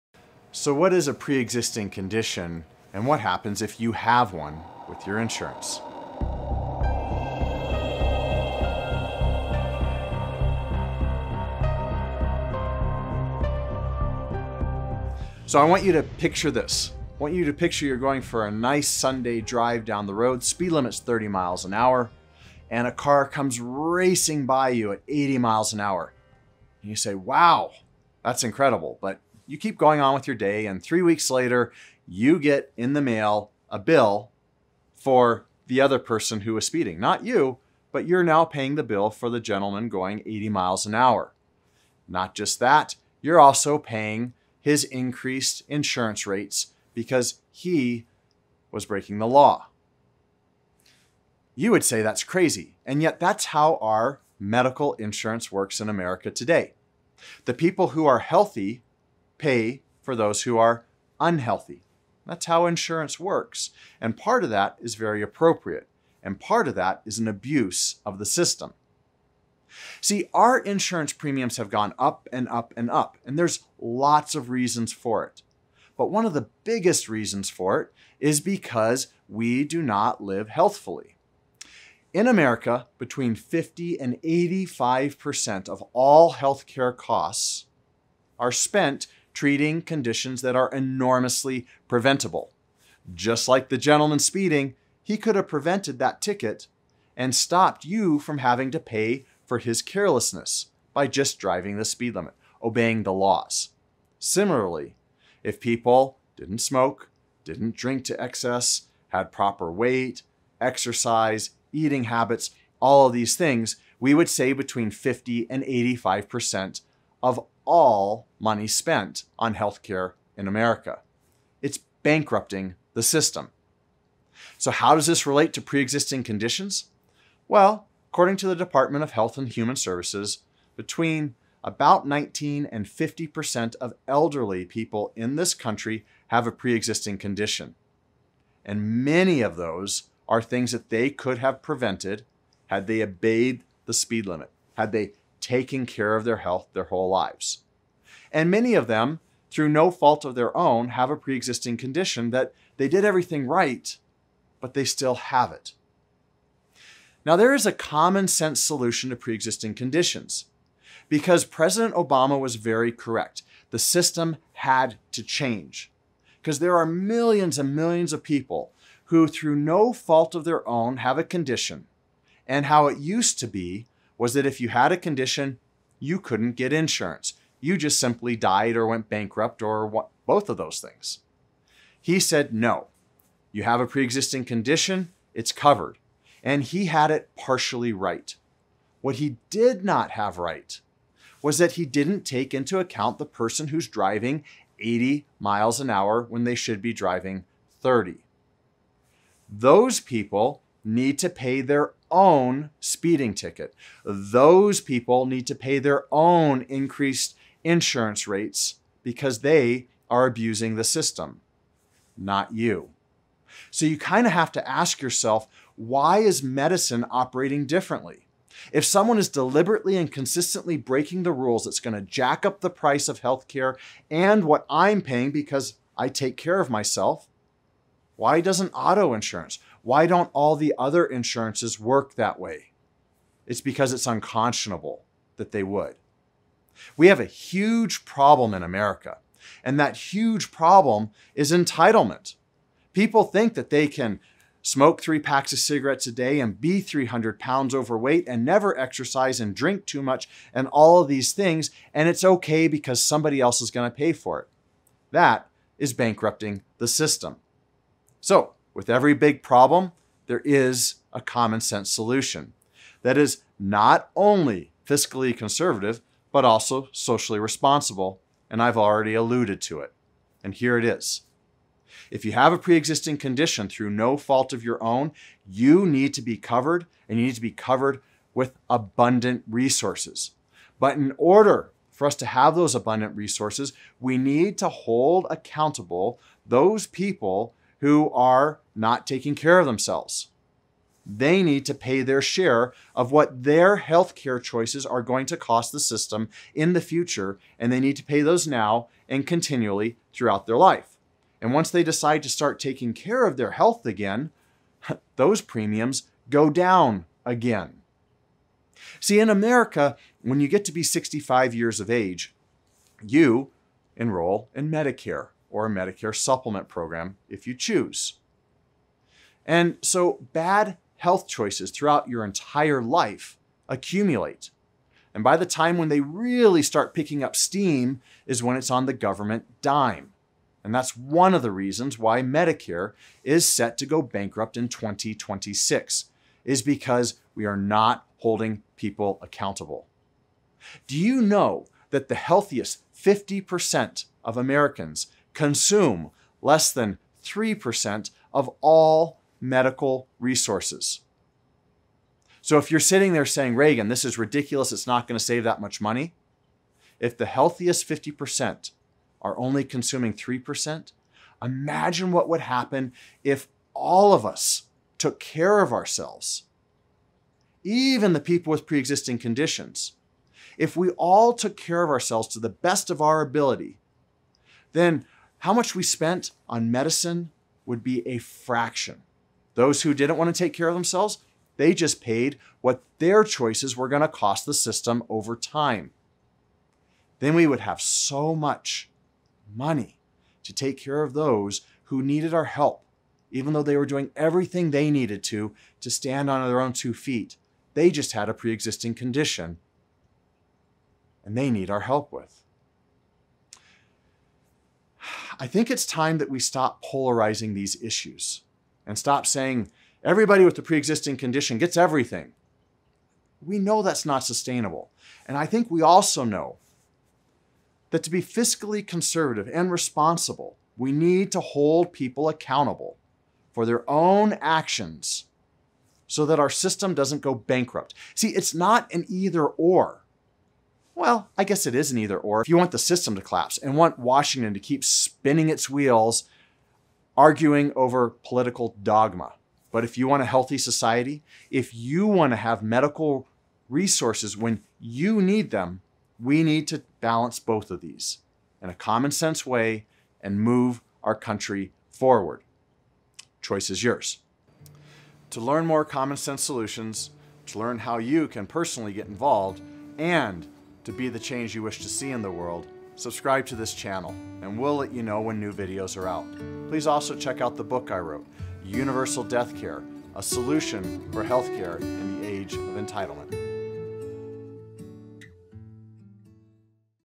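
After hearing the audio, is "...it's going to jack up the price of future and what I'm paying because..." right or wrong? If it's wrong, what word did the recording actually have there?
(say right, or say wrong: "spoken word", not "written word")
wrong: "healthcare", not "future".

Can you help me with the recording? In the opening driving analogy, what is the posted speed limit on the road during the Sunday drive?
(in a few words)
30 miles an hour.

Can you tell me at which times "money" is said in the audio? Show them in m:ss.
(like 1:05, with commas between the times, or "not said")
1:58, 5:55, 6:29.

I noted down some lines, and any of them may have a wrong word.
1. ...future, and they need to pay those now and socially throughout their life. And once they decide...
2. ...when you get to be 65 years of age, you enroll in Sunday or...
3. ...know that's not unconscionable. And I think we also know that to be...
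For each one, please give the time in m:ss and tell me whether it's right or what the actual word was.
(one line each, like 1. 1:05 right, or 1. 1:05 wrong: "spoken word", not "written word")
1. 4:56 wrong: "continually", not "socially"
2. 5:10 wrong: "Medicare", not "Sunday"
3. 6:53 wrong: "sustainable", not "unconscionable".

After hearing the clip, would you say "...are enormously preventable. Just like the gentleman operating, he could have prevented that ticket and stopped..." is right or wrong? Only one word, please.
wrong.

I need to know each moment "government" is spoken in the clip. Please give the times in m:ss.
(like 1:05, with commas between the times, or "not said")
5:28.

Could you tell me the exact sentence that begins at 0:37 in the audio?
Not you, but you're now paying the bill for the gentleman going 80 miles an hour.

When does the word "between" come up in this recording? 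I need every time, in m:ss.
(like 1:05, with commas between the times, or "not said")
1:22, 1:54, 2:10.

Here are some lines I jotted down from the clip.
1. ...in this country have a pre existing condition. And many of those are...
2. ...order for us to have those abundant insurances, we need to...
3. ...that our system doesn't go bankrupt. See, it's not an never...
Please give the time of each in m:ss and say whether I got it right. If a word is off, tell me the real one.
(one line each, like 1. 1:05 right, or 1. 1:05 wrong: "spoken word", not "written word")
1. 2:15 right
2. 4:41 wrong: "resources", not "insurances"
3. 7:06 wrong: "either", not "never".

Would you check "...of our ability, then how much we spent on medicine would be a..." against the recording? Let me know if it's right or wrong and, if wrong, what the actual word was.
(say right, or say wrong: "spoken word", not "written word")
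right.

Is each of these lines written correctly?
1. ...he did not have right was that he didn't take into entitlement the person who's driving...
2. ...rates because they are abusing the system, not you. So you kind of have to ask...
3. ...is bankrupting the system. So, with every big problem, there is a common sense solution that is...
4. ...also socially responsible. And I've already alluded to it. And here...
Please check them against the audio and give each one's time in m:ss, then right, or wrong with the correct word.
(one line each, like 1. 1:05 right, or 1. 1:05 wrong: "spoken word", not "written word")
1. 3:09 wrong: "account", not "entitlement"
2. 3:28 right
3. 4:15 right
4. 4:26 right.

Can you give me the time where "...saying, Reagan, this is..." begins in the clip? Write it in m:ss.
5:53.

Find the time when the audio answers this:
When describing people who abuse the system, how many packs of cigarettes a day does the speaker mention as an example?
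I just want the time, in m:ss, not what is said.
4:05.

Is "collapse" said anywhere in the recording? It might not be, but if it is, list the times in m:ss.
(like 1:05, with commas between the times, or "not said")
7:13.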